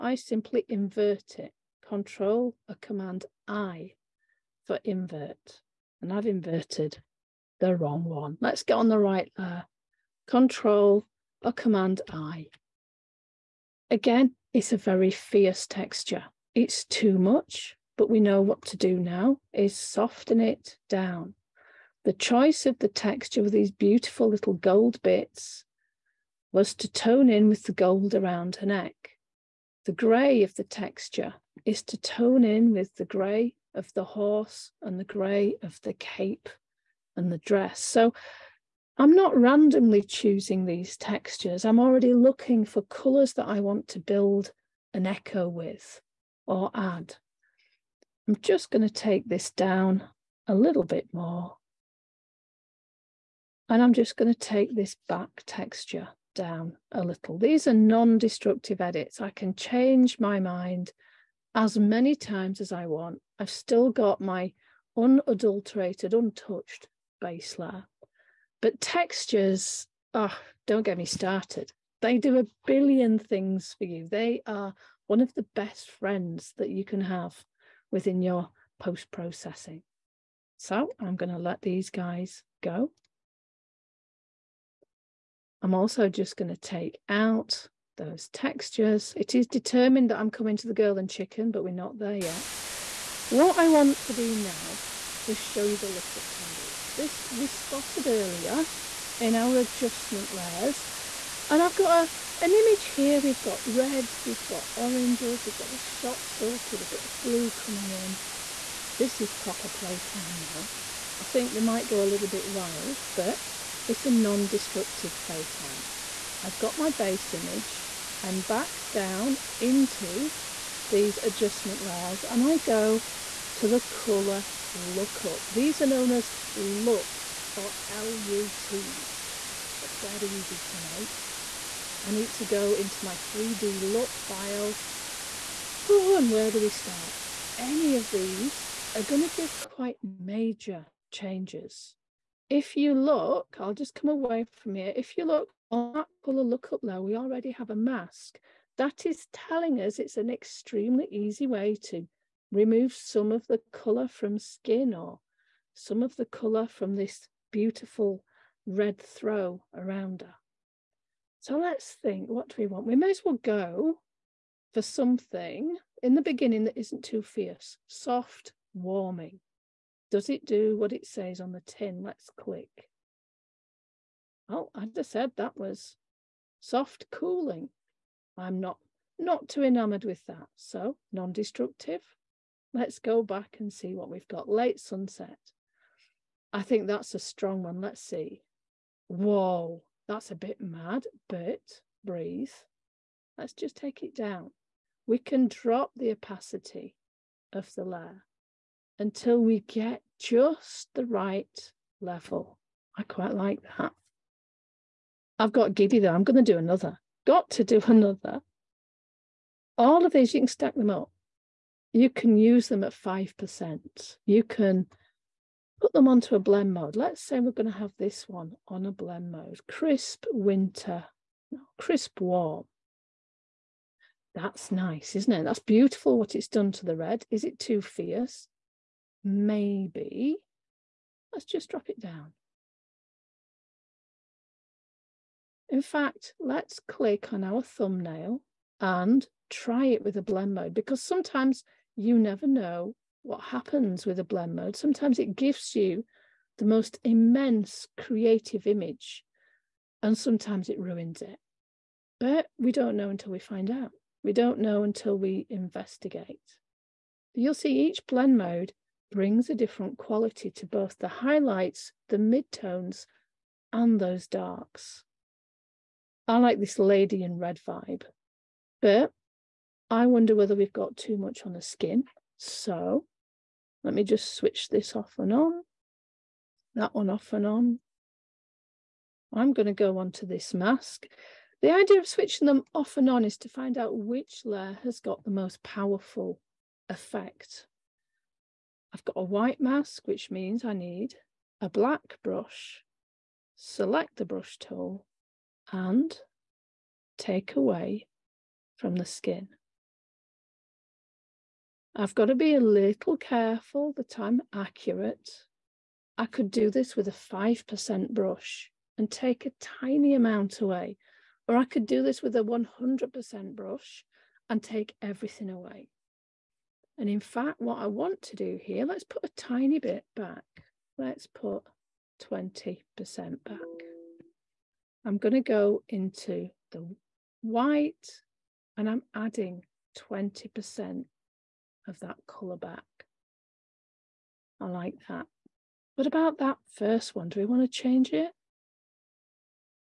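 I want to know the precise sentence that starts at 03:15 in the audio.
We can drop the opacity of the layer until we get just the right level.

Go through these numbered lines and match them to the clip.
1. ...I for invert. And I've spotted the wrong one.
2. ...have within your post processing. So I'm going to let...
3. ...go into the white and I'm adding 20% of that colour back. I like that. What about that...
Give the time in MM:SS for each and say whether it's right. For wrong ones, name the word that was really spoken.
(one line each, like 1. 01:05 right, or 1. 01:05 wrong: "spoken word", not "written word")
1. 00:03 wrong: "inverted", not "spotted"
2. 01:17 right
3. 05:25 right.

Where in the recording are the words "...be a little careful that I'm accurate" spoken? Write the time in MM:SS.
05:02.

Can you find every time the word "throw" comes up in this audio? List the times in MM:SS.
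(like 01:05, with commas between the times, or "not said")
02:39.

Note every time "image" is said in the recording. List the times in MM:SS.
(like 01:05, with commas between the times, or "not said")
01:42, 01:57, 04:08.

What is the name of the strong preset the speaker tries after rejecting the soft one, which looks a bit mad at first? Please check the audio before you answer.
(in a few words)
Late sunset.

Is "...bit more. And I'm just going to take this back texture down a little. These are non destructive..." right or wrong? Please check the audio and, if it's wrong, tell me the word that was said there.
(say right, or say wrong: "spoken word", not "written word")
right.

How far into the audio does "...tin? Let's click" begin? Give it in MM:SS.
02:51.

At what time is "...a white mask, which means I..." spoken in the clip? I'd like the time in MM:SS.
04:49.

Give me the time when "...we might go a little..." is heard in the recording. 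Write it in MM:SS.
01:51.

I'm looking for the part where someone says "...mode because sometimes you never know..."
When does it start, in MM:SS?
04:00.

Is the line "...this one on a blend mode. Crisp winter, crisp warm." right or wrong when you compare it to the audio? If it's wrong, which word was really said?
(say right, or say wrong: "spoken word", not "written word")
right.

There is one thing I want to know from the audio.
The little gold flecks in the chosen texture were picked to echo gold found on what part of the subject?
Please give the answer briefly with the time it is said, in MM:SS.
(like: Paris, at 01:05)
Around her neck, at 00:28.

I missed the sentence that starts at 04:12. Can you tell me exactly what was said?
But we don't know until we find out.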